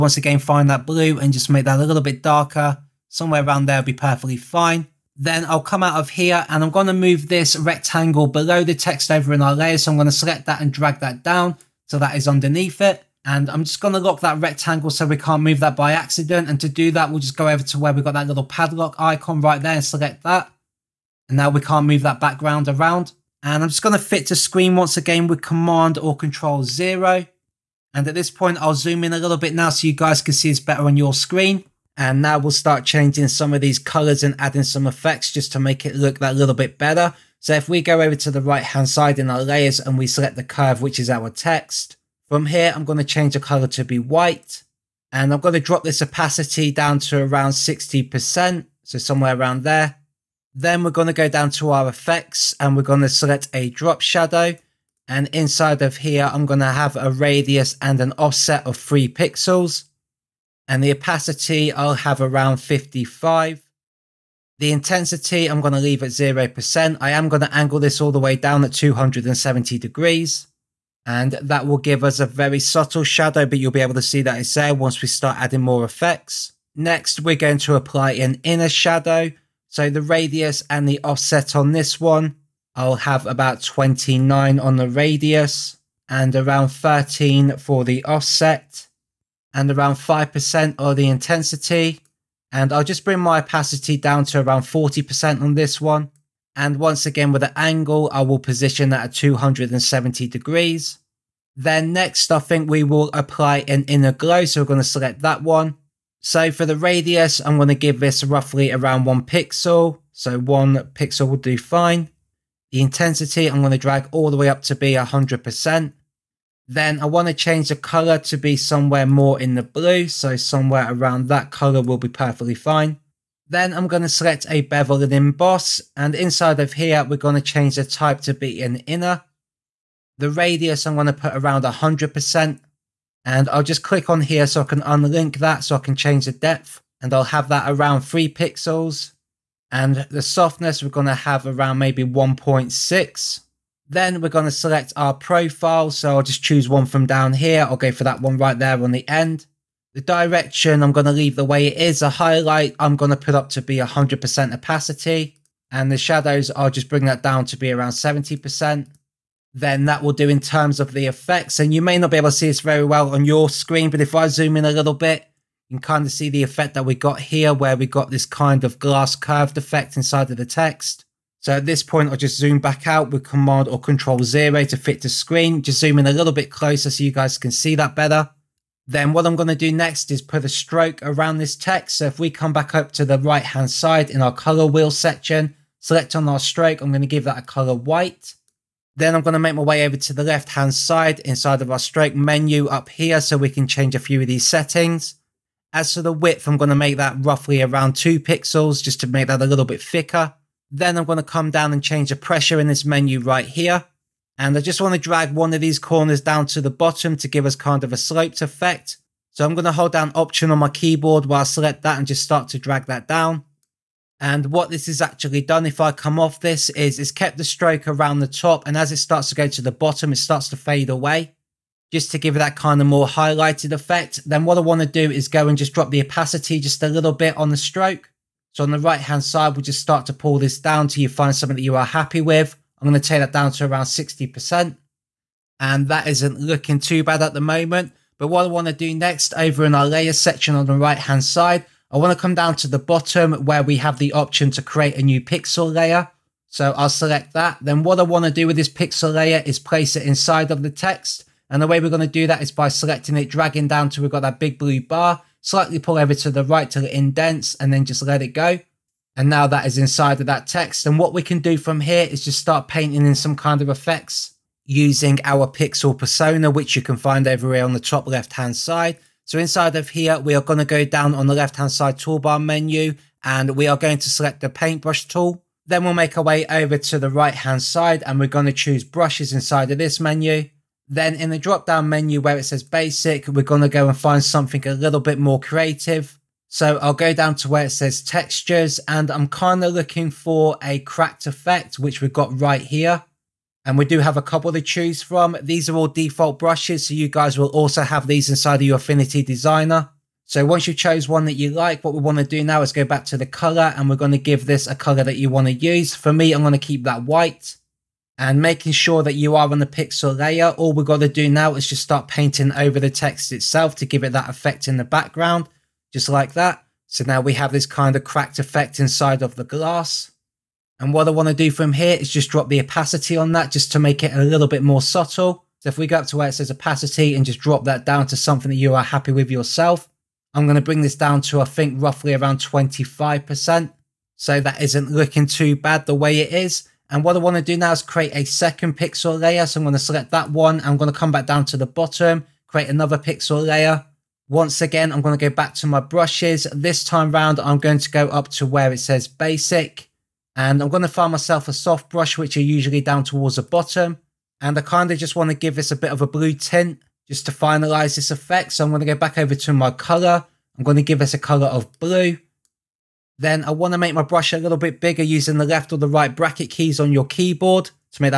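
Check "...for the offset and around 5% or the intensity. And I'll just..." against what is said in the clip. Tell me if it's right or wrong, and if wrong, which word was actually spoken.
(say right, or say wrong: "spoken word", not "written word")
right.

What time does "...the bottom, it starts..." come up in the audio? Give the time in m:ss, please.
3:39.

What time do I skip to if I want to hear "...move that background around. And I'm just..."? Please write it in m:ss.
0:21.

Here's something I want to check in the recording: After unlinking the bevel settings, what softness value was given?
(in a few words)
1.6.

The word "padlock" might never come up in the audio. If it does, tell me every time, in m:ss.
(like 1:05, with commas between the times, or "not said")
0:18.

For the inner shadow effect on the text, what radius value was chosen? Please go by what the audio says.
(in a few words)
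29.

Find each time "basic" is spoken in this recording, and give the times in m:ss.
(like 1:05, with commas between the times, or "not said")
4:42, 5:49.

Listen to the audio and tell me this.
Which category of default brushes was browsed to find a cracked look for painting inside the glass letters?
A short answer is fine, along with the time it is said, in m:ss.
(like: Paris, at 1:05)
Textures, at 4:48.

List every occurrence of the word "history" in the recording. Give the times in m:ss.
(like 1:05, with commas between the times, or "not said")
not said.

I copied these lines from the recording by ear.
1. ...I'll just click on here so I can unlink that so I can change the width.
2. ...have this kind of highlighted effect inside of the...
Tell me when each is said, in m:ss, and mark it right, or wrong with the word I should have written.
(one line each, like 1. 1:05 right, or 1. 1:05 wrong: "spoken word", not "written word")
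1. 2:13 wrong: "depth", not "width"
2. 5:17 wrong: "cracked", not "highlighted".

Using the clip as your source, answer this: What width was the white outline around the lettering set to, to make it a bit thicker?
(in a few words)
2 pixels.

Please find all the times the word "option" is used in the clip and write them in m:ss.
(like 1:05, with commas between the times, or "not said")
3:30, 4:04.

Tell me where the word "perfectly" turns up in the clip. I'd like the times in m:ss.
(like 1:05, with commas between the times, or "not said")
0:03, 2:02.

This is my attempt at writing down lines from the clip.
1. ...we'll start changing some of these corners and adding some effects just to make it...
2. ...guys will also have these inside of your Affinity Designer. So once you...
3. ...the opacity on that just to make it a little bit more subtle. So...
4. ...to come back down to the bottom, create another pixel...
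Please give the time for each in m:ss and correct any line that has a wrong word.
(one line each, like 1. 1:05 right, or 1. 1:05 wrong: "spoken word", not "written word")
1. 0:32 wrong: "colors", not "corners"
2. 4:57 right
3. 5:22 right
4. 5:40 right.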